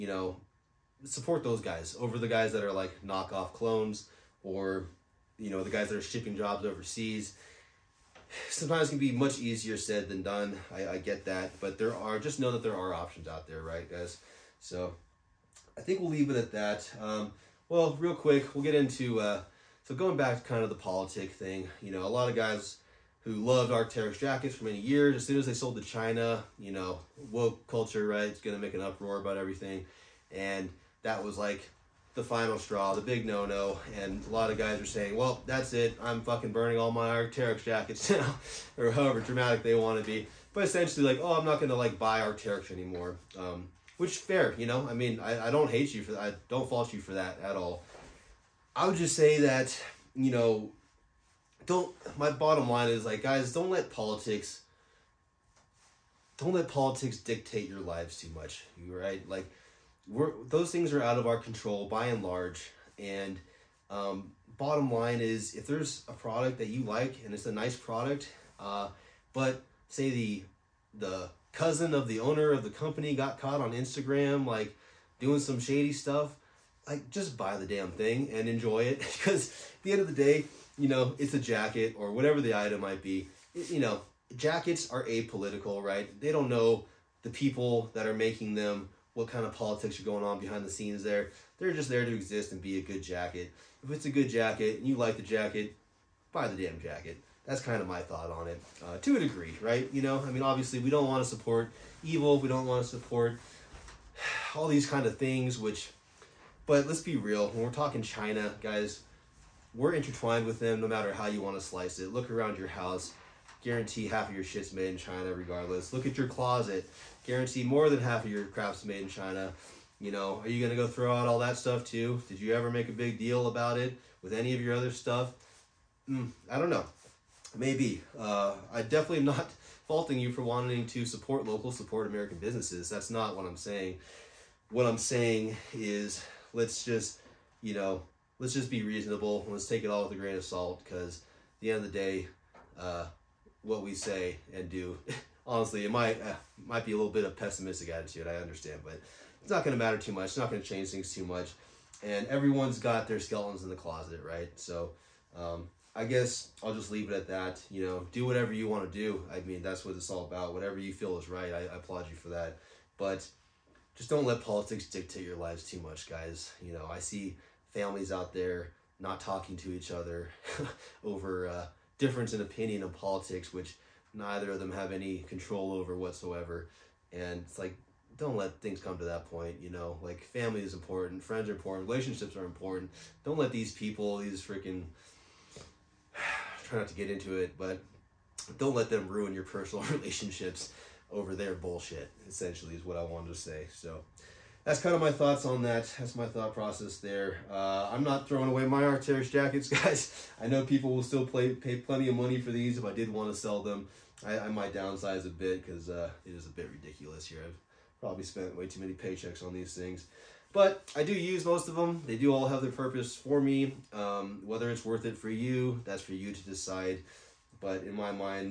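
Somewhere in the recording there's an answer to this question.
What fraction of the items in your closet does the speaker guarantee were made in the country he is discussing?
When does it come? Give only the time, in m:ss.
1:57.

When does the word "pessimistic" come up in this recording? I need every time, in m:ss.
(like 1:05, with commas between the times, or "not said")
2:27.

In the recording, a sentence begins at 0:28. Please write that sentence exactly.
It's going to make an uproar about everything.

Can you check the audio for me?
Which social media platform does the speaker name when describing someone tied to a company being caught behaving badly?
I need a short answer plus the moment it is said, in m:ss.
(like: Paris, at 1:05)
Instagram, at 1:13.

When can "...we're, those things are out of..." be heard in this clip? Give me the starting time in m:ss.
1:00.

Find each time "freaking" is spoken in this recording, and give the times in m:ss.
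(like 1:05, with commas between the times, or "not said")
3:04.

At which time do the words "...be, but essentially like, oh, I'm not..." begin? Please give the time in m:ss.
0:40.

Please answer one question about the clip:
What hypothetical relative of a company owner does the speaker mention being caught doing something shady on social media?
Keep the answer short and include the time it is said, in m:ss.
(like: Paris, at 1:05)
The cousin, at 1:11.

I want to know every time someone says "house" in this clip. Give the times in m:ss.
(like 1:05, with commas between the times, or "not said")
1:52.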